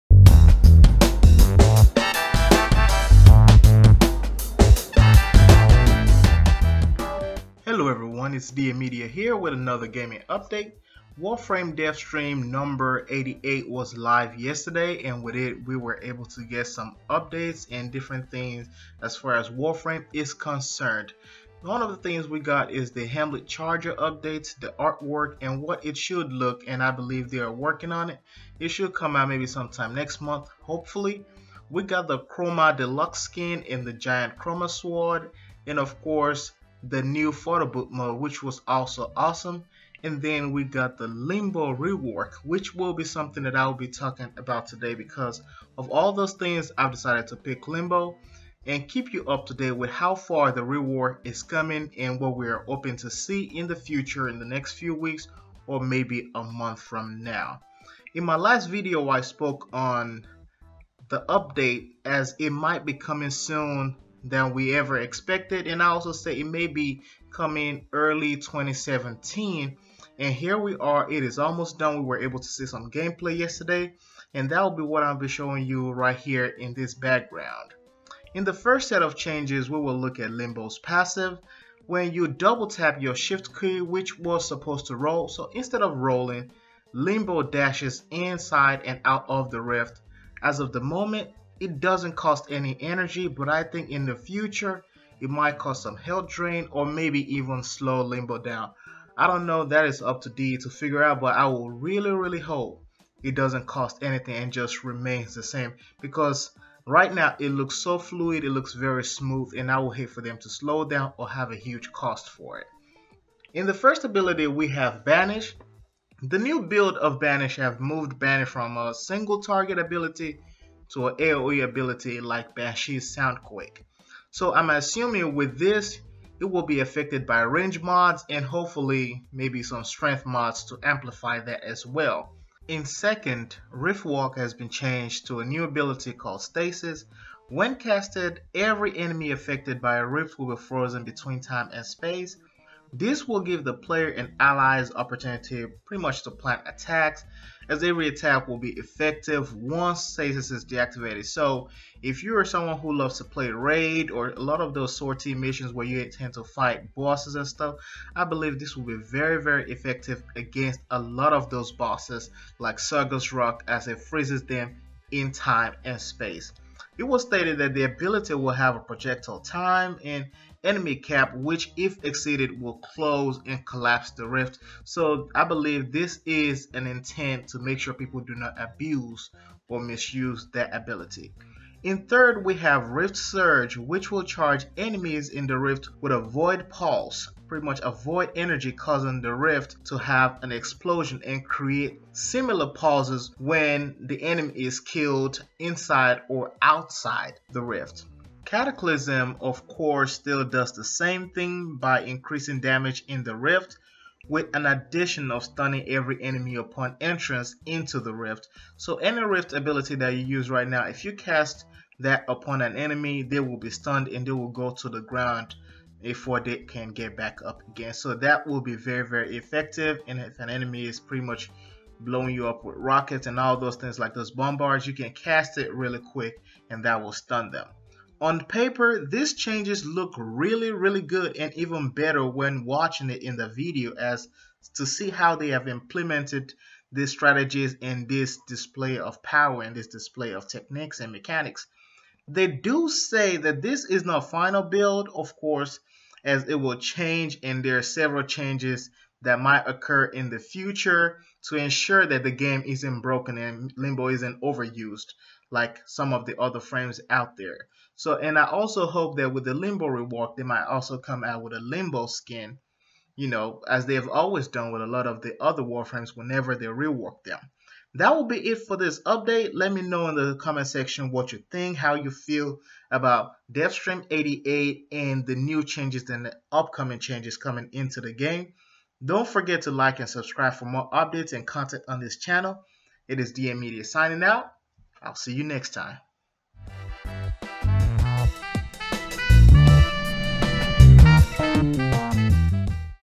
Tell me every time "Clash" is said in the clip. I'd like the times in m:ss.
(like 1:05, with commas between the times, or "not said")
not said.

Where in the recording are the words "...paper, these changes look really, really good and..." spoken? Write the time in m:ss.
3:48.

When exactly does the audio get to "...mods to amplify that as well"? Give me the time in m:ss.
2:10.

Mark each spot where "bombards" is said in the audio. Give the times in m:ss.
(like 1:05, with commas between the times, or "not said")
3:44.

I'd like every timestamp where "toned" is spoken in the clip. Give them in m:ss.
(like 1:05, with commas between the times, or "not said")
not said.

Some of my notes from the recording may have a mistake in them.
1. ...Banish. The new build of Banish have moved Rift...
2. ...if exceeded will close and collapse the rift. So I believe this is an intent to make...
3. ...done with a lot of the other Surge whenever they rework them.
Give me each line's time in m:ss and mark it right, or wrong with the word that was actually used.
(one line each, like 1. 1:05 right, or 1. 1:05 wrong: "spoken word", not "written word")
1. 1:55 wrong: "Banish", not "Rift"
2. 2:51 right
3. 4:24 wrong: "Warframes", not "Surge".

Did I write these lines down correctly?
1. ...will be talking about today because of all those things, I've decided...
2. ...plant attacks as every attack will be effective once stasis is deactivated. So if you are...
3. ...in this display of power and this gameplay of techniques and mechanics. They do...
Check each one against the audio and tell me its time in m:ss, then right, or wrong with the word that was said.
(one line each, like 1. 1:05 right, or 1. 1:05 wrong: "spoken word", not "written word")
1. 0:43 right
2. 2:26 right
3. 3:57 wrong: "display", not "gameplay".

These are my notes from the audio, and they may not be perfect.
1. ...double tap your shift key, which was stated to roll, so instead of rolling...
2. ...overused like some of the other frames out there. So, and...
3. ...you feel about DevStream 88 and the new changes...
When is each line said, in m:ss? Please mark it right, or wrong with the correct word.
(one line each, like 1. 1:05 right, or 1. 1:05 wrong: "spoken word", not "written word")
1. 1:22 wrong: "supposed", not "stated"
2. 4:14 right
3. 4:31 right.